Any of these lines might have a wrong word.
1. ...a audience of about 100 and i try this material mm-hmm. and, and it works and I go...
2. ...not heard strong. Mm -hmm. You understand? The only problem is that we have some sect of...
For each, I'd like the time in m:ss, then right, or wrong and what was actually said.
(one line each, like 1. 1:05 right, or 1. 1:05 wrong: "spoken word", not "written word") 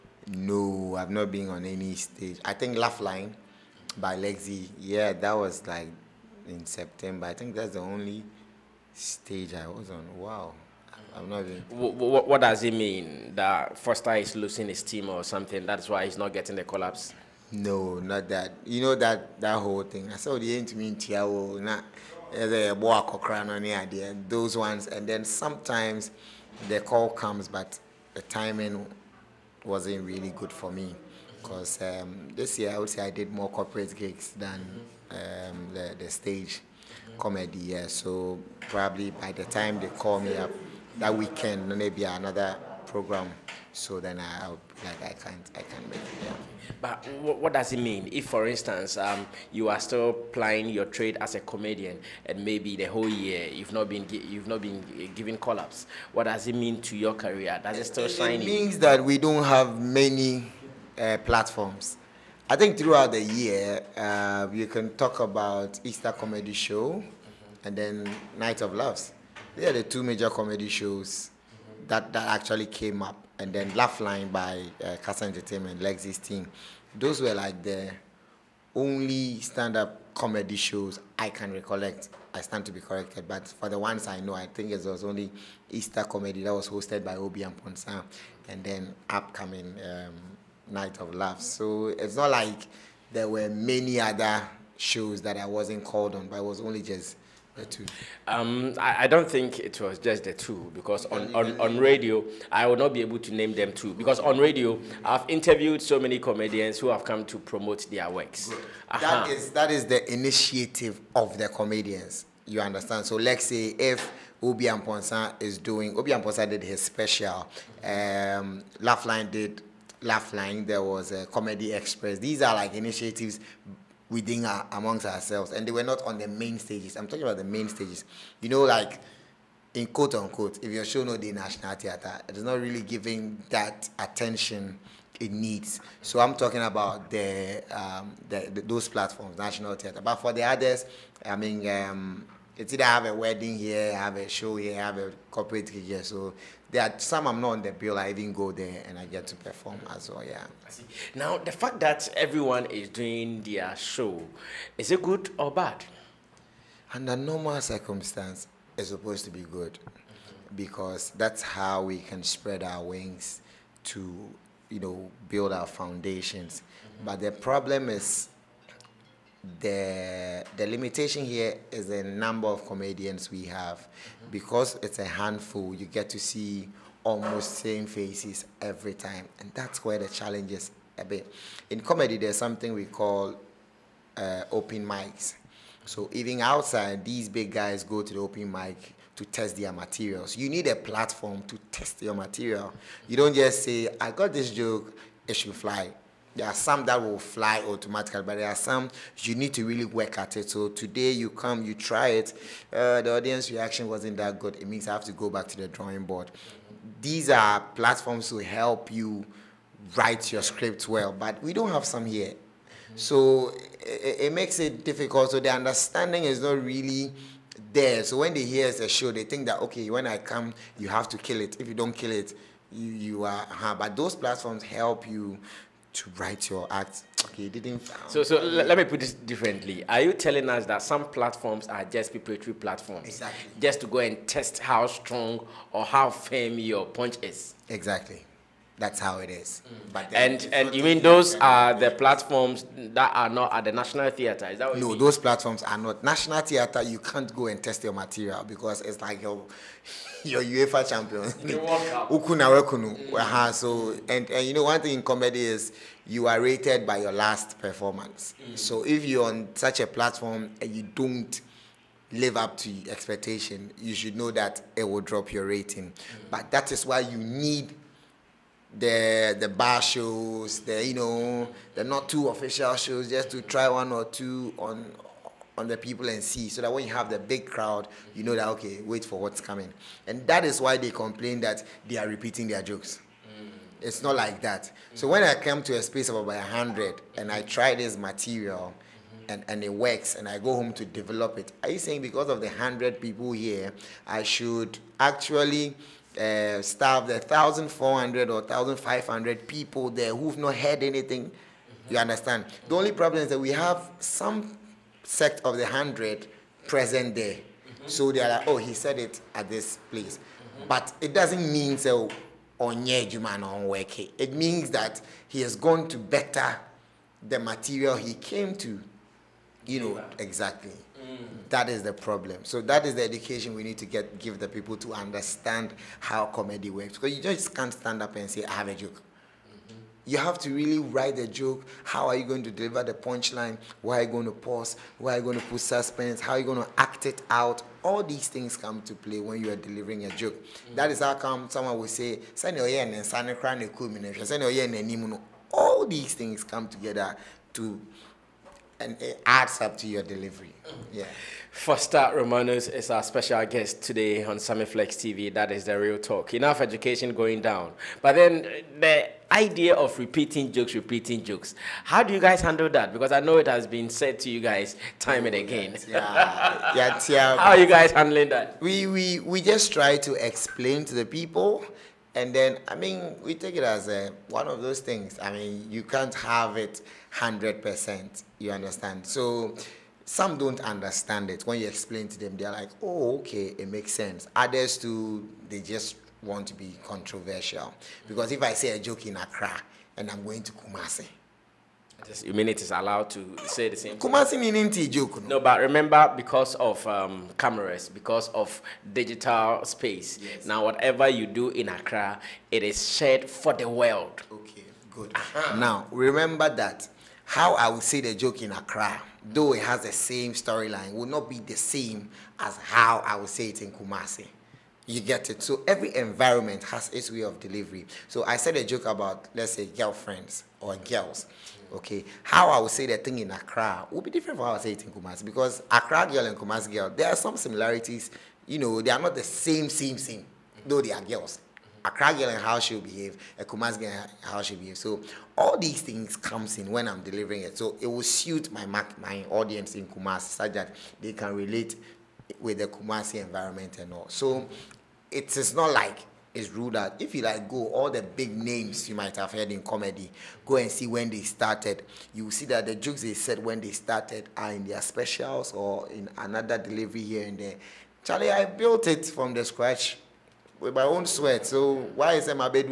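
1. 4:45 wrong: "space", not "audience"
2. 5:00 wrong: "anything", not "strong".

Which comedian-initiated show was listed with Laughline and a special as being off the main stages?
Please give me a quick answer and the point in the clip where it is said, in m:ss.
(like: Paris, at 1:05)
Comedy Express, at 2:01.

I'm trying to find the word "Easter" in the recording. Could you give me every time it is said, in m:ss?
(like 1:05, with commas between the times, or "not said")
1:05, 1:25.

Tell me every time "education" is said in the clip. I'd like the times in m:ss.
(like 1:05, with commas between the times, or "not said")
5:23, 5:56.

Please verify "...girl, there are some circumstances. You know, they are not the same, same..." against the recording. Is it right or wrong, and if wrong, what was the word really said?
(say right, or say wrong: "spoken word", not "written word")
wrong: "similarities", not "circumstances".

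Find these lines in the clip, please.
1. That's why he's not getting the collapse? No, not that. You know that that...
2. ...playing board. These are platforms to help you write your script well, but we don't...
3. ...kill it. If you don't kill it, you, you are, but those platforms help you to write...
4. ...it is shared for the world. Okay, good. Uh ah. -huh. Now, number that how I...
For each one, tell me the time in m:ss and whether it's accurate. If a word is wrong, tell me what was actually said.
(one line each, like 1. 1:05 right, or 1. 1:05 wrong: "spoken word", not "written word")
1. 0:15 right
2. 3:25 wrong: "drawing", not "playing"
3. 3:41 right
4. 6:42 wrong: "remember", not "number".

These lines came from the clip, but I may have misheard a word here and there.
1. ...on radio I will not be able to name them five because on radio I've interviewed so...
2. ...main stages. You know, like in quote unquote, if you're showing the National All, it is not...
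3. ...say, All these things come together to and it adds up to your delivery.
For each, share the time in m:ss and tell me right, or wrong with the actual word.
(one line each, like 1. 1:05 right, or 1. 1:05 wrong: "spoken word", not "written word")
1. 1:41 wrong: "two", not "five"
2. 2:07 wrong: "Theatre", not "All"
3. 5:41 right.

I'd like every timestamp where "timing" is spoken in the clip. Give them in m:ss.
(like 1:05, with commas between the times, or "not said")
0:28.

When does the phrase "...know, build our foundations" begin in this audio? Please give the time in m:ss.
2:44.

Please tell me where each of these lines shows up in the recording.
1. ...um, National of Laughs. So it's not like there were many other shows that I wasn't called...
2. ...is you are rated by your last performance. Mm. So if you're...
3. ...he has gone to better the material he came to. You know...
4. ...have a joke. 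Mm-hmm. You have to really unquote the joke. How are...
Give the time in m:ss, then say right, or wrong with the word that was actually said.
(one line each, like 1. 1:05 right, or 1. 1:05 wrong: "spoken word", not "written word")
1. 1:29 wrong: "Night", not "National"
2. 4:15 right
3. 5:15 right
4. 5:28 wrong: "write", not "unquote".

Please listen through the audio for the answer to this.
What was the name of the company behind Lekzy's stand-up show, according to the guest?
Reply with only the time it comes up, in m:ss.
1:15.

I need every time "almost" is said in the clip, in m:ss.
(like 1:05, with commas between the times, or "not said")
2:57.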